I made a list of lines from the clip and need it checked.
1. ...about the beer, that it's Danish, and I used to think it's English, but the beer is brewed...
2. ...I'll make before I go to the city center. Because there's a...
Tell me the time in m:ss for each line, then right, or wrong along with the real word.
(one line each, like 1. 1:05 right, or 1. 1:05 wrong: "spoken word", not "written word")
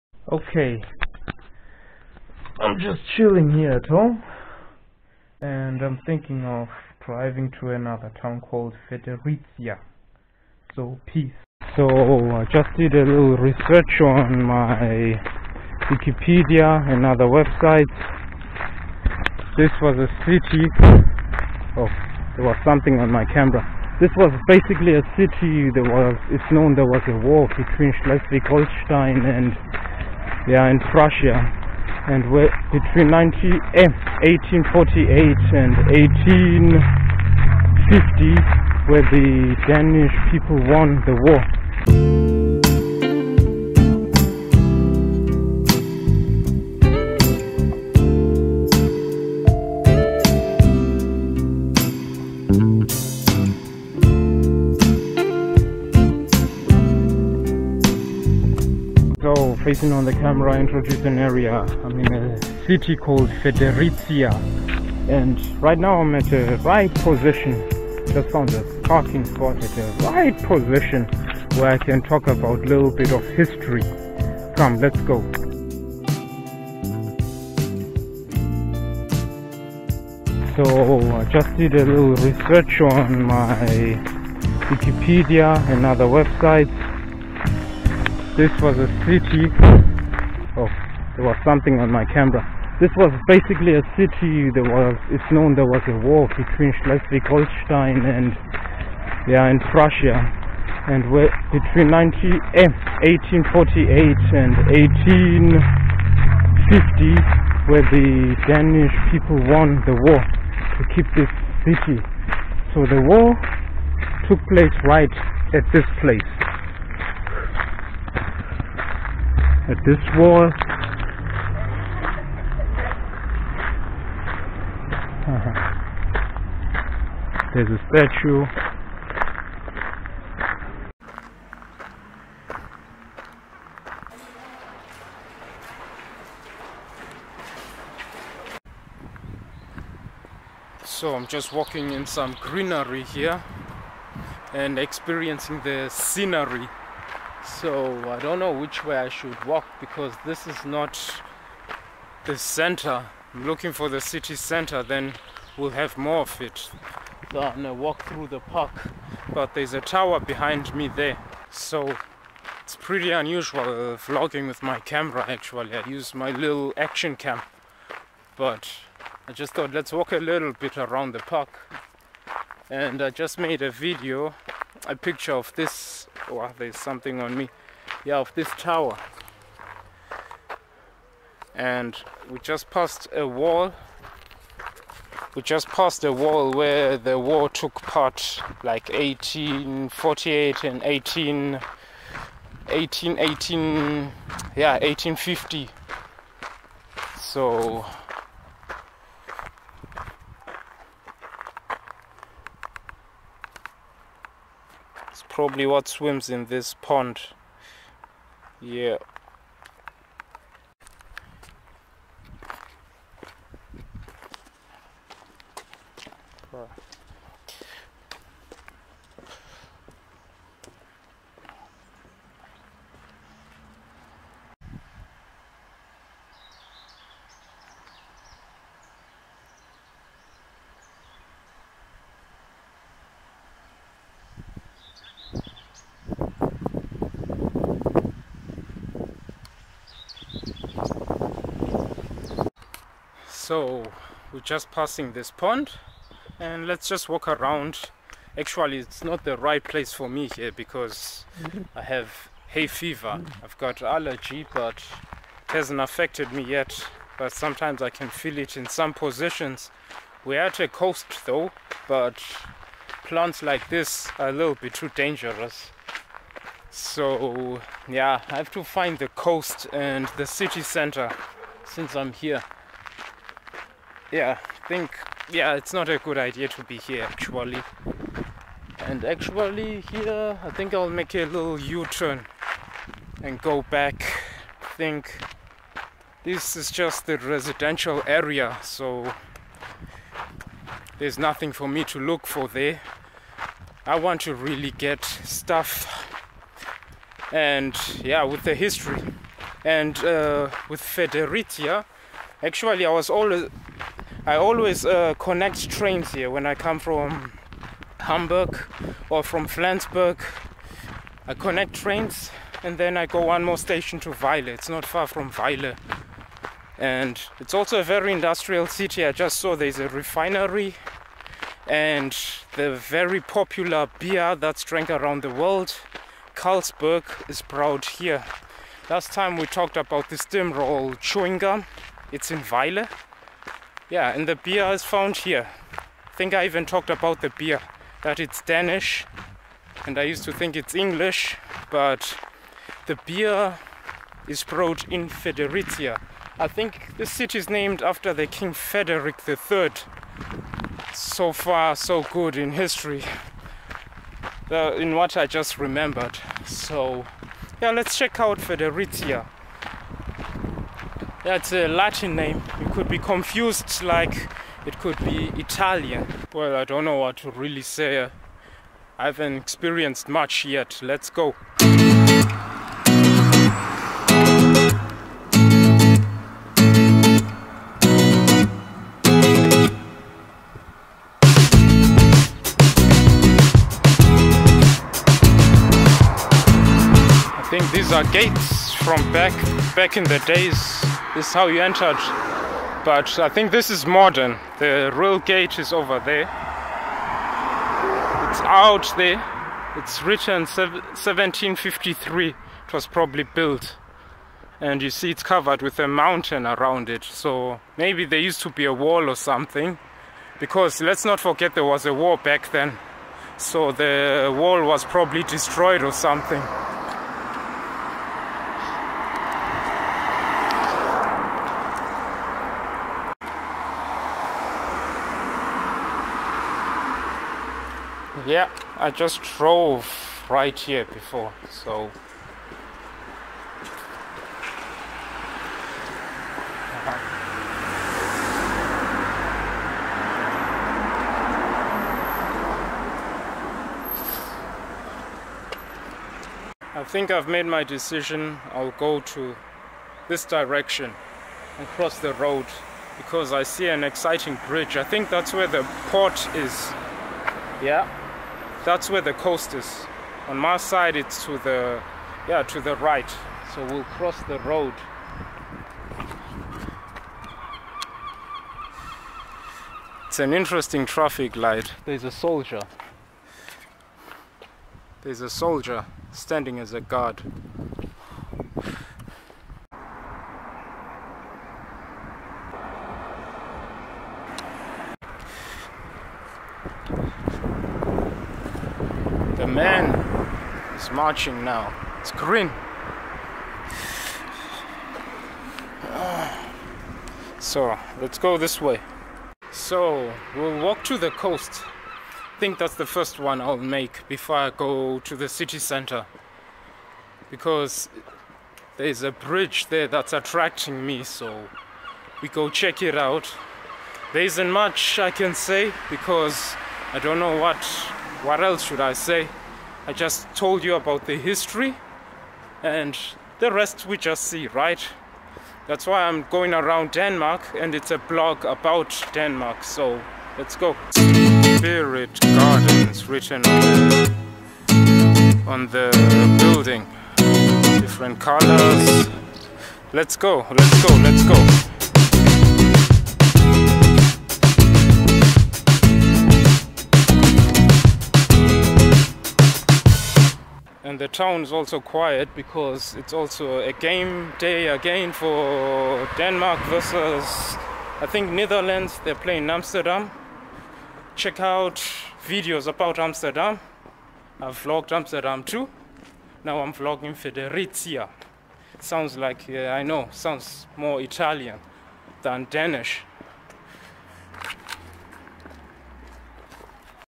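1. 5:36 right
2. 8:23 right.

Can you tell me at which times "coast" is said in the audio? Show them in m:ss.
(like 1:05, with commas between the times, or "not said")
4:20, 4:29, 7:39, 8:21.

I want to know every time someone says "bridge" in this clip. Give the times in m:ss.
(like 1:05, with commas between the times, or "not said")
7:34, 8:29.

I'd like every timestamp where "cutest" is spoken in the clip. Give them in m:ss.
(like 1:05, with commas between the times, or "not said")
not said.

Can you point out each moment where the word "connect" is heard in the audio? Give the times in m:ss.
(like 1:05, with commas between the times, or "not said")
5:05, 5:11.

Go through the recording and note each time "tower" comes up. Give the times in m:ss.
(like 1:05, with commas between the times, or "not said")
2:39, 2:58.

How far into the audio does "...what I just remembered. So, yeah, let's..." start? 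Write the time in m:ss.
5:54.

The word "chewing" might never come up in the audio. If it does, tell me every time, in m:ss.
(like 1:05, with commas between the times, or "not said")
5:30.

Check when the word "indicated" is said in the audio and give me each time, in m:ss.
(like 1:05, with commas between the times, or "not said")
not said.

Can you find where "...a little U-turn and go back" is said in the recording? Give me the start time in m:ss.
4:41.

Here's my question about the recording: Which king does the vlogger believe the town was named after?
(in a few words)
King Frederick III.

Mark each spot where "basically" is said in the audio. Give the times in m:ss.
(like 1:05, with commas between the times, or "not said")
0:24, 1:33.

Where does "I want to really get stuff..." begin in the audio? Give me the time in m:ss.
4:53.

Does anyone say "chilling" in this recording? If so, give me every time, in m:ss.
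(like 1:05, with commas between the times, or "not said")
0:03.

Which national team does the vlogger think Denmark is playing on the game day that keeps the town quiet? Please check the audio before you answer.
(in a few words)
Netherlands.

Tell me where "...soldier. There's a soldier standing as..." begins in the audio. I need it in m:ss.
7:52.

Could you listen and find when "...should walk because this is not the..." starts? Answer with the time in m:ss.
2:29.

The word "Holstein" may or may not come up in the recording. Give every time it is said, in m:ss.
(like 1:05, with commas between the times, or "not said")
0:28, 1:36.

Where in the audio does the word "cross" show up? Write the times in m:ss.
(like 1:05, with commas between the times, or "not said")
7:31, 7:43.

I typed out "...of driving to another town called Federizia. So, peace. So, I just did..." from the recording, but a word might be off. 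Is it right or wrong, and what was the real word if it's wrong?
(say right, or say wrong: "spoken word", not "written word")
right.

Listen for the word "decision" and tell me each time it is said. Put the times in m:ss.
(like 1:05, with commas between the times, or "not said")
7:27.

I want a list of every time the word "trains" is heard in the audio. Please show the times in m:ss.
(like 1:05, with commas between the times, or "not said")
5:05, 5:11.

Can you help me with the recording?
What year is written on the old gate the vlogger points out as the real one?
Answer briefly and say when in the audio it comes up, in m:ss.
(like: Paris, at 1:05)
1753, at 6:40.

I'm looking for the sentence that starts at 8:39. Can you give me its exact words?
I just told you about the history and the rest we just see, right?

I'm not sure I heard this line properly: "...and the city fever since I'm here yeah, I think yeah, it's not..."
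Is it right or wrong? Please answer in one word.
wrong.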